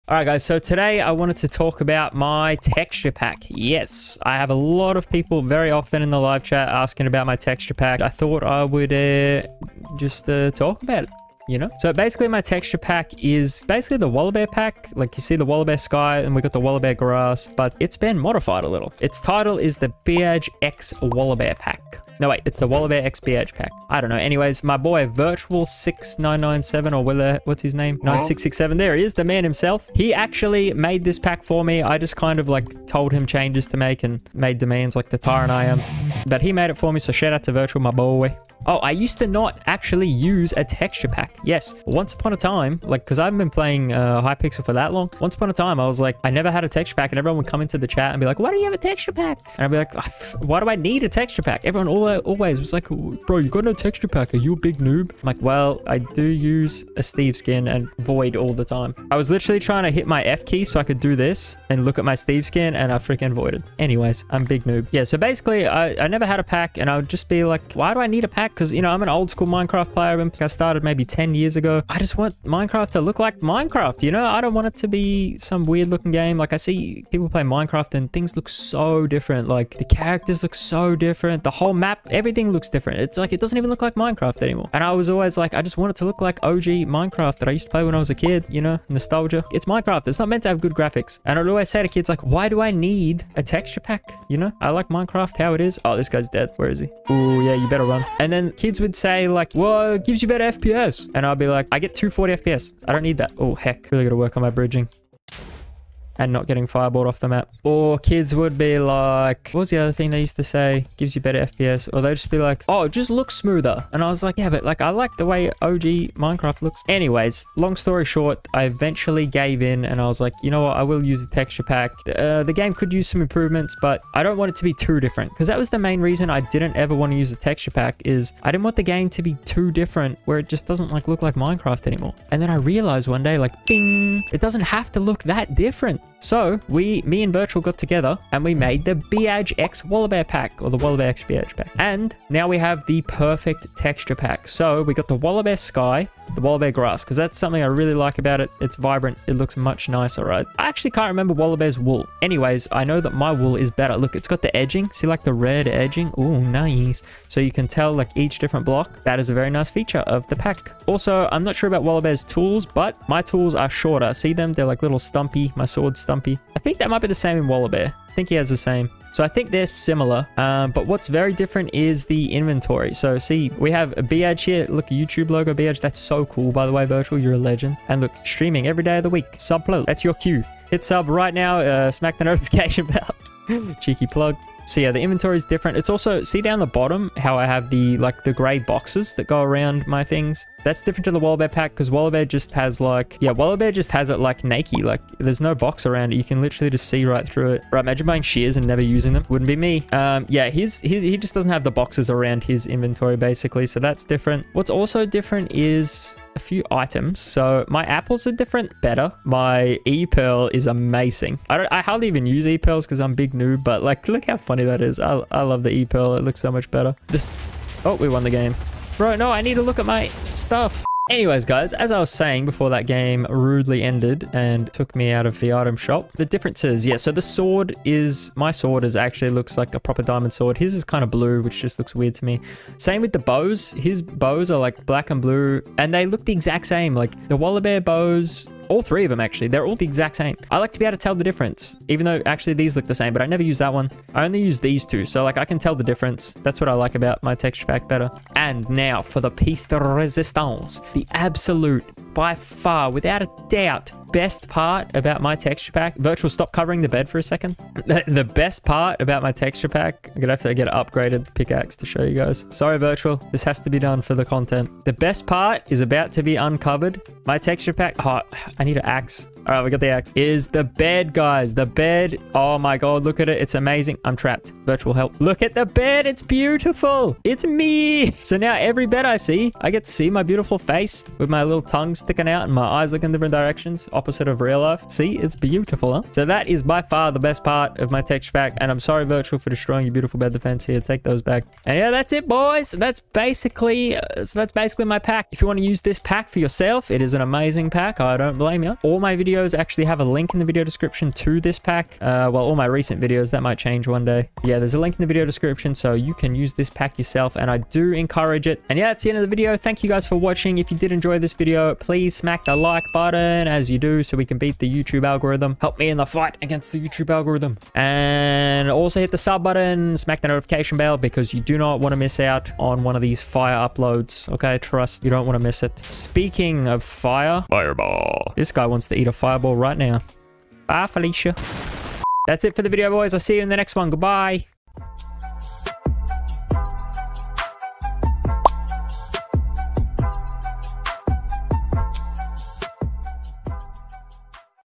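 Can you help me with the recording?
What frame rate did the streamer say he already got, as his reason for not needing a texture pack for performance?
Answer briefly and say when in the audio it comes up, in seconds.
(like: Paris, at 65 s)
240 FPS, at 101 s.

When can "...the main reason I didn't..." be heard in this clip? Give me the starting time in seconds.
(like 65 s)
125 s.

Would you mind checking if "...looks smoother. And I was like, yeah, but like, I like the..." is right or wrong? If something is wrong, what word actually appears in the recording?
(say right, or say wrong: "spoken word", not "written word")
right.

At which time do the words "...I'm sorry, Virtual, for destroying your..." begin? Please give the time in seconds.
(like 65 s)
288 s.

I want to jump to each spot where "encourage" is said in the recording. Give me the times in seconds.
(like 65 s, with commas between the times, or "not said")
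307 s.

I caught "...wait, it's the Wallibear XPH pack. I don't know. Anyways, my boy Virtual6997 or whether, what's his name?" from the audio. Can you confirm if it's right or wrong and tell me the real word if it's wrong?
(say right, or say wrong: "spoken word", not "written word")
right.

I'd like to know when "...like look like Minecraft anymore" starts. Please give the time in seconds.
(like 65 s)
130 s.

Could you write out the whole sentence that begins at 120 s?
I will use the texture pack.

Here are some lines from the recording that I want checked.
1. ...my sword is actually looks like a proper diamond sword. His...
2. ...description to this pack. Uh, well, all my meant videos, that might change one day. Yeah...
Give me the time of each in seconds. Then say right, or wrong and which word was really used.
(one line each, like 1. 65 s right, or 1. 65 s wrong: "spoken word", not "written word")
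1. 228 s right
2. 300 s wrong: "recent", not "meant".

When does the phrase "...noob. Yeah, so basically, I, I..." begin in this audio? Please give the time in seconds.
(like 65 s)
64 s.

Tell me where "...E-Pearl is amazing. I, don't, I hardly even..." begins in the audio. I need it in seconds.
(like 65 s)
209 s.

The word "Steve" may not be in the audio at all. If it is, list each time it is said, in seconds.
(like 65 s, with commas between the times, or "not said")
57 s, 62 s.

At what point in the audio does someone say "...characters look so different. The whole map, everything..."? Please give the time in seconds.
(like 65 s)
79 s.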